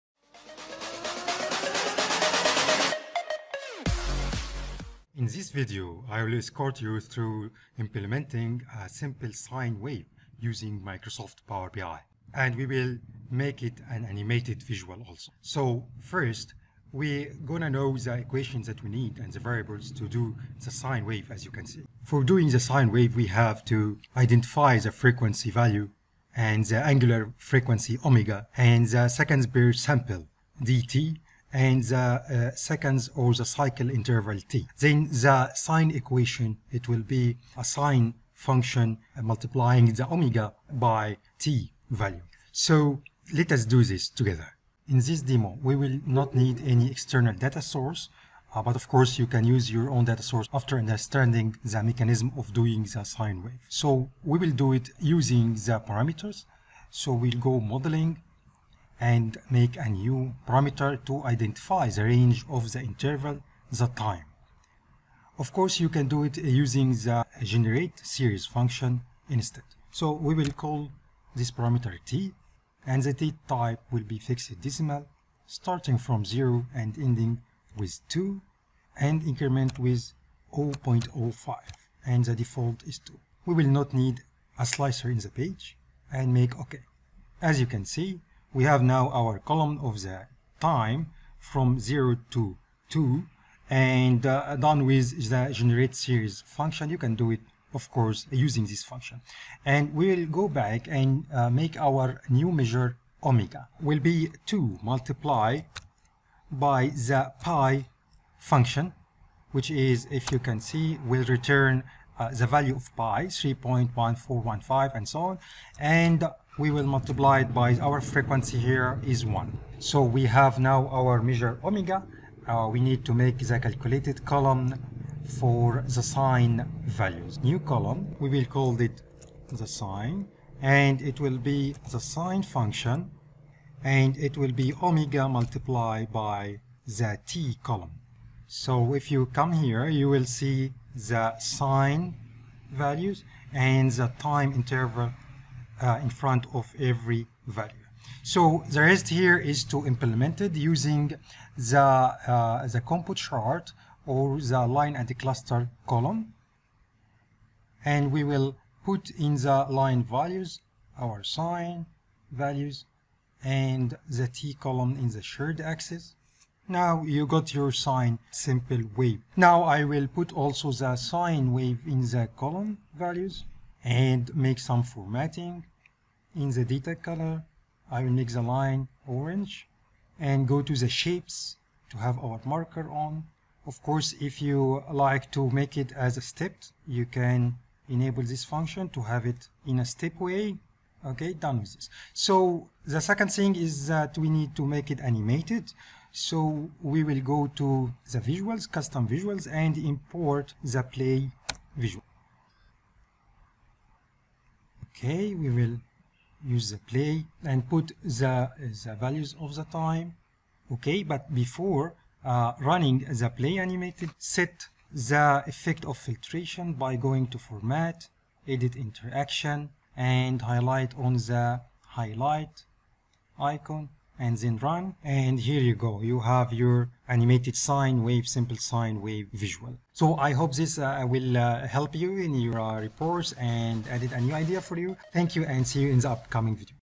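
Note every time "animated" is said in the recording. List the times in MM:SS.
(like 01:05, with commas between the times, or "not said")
00:14, 03:15, 03:33, 03:47.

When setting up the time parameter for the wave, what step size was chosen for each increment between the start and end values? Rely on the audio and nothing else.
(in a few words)
0.05.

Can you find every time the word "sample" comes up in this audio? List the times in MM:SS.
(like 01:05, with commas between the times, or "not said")
00:29.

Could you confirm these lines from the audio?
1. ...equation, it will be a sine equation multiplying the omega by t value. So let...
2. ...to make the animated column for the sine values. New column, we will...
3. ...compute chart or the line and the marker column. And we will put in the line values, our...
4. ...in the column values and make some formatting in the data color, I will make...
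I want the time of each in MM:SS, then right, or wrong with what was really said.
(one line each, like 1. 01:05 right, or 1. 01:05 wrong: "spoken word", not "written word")
1. 00:35 wrong: "function", not "equation"
2. 02:03 wrong: "calculated", not "animated"
3. 02:32 wrong: "cluster", not "marker"
4. 02:51 right.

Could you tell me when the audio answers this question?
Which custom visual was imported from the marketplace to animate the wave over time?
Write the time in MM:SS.
03:20.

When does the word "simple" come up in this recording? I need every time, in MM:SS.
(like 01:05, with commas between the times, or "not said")
00:08, 02:48, 03:48.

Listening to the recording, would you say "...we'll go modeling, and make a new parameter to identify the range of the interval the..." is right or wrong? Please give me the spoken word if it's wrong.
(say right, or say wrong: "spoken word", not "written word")
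right.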